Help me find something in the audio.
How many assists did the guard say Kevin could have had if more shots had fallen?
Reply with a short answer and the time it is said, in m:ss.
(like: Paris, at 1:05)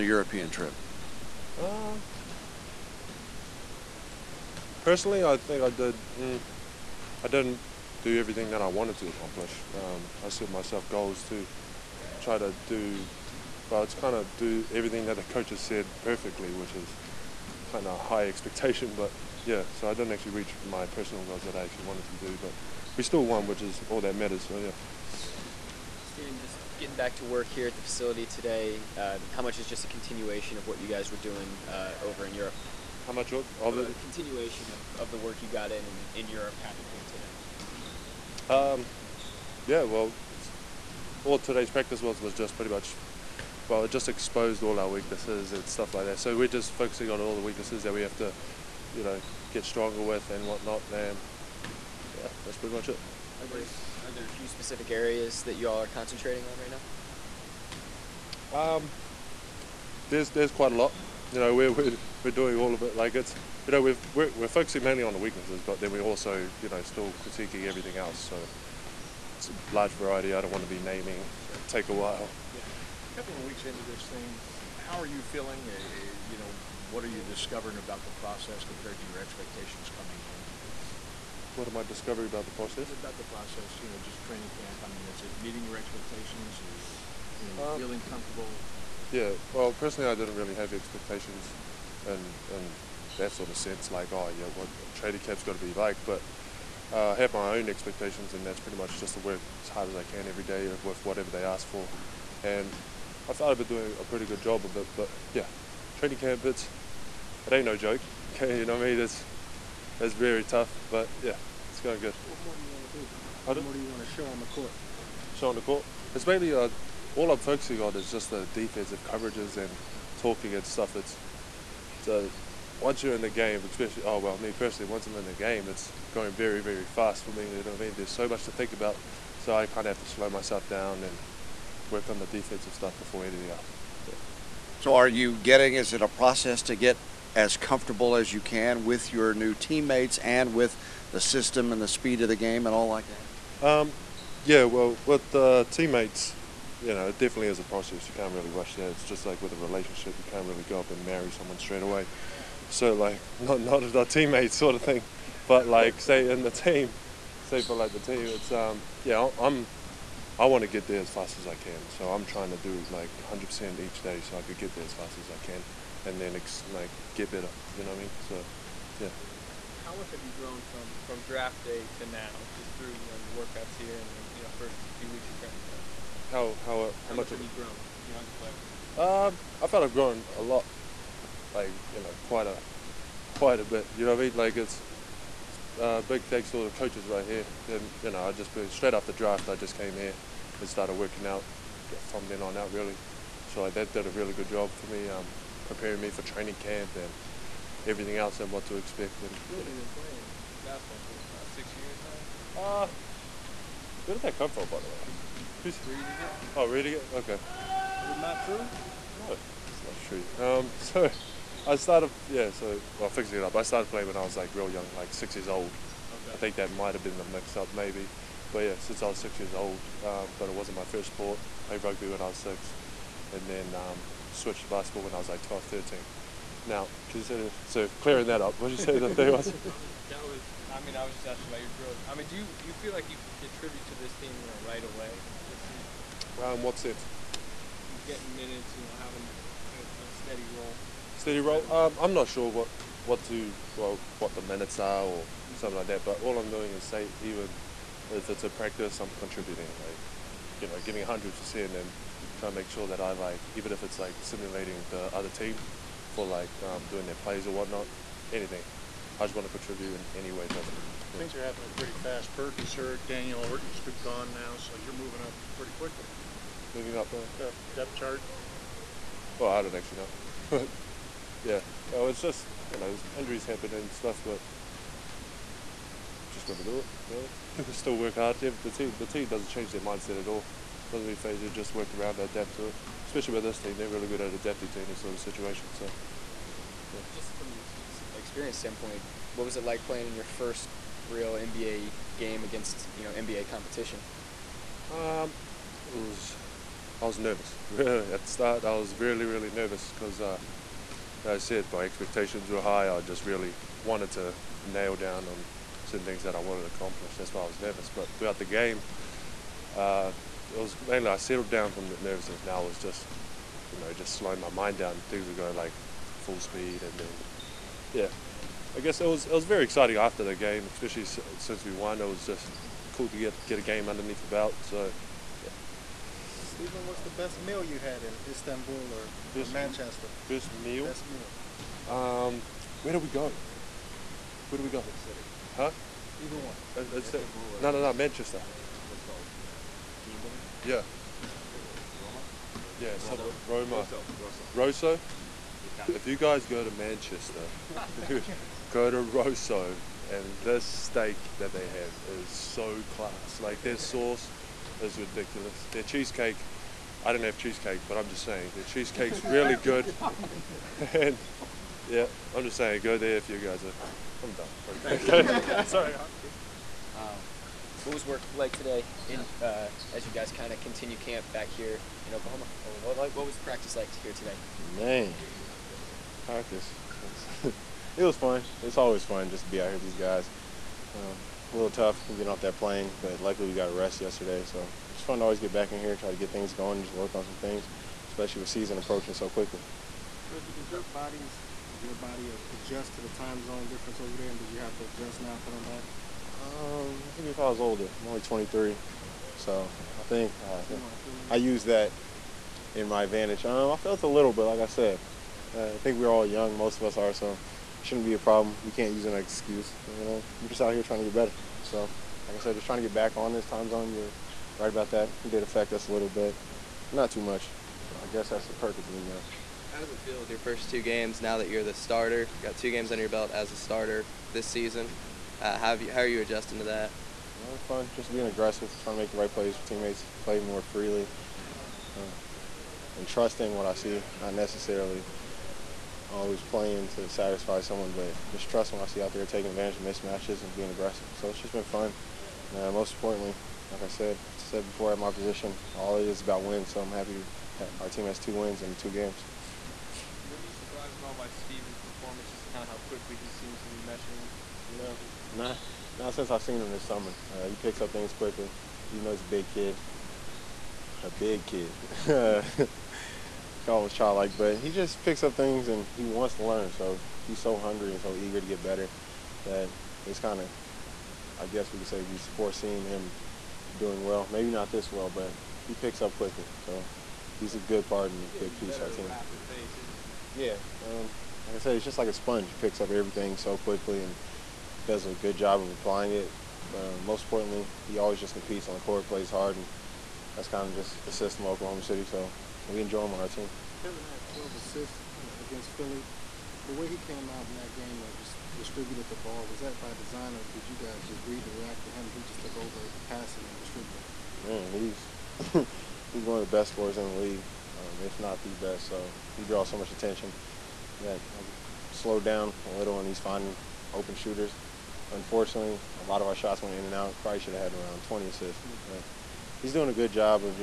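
20, at 8:37.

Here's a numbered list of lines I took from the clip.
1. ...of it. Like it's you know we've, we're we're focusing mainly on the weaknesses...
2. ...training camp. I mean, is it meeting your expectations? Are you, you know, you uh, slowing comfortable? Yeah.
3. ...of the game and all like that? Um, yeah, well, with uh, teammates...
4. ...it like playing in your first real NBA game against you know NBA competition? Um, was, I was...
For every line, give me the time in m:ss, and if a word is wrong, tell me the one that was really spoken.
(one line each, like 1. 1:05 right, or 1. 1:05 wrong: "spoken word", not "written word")
1. 1:02 right
2. 1:24 wrong: "feeling", not "slowing"
3. 2:22 right
4. 4:49 right.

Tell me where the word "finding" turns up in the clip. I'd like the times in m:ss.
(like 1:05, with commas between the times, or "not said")
8:33.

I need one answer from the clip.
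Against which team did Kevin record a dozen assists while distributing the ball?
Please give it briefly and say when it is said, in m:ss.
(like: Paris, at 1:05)
Philly, at 8:15.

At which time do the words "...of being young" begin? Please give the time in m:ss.
6:58.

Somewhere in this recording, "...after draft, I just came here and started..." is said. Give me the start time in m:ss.
3:08.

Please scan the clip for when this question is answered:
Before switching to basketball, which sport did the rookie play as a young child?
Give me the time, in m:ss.
3:41.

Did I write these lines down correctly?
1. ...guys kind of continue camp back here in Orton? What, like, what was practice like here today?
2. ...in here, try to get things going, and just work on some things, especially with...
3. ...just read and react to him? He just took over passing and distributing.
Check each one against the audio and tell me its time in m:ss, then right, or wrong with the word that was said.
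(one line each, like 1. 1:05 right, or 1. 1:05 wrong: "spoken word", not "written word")
1. 6:10 wrong: "Oklahoma", not "Orton"
2. 6:25 right
3. 8:21 right.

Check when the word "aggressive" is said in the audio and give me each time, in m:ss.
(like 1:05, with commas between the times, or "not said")
7:08, 7:20.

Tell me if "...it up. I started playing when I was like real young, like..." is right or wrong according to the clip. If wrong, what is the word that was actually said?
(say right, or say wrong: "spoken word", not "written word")
right.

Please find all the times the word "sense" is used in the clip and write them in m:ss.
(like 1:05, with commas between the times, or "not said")
1:33, 3:56.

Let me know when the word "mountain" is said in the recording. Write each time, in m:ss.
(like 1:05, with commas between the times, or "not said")
not said.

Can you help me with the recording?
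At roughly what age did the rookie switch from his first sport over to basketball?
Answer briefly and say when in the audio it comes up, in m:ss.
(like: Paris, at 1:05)
12, at 3:45.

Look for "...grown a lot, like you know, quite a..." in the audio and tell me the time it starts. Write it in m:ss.
2:59.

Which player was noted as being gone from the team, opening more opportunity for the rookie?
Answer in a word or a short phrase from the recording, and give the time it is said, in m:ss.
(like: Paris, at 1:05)
Daniel Orton, at 4:23.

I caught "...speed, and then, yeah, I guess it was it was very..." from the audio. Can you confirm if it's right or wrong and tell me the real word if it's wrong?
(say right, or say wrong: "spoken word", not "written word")
right.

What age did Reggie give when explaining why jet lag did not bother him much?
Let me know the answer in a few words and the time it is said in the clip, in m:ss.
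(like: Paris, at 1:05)
23, at 6:38.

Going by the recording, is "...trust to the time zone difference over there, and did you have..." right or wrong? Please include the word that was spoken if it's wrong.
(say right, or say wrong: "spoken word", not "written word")
wrong: "adjust", not "trust".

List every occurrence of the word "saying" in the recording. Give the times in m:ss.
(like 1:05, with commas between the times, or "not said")
5:58, 6:02.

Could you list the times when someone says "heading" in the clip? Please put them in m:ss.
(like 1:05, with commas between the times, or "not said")
not said.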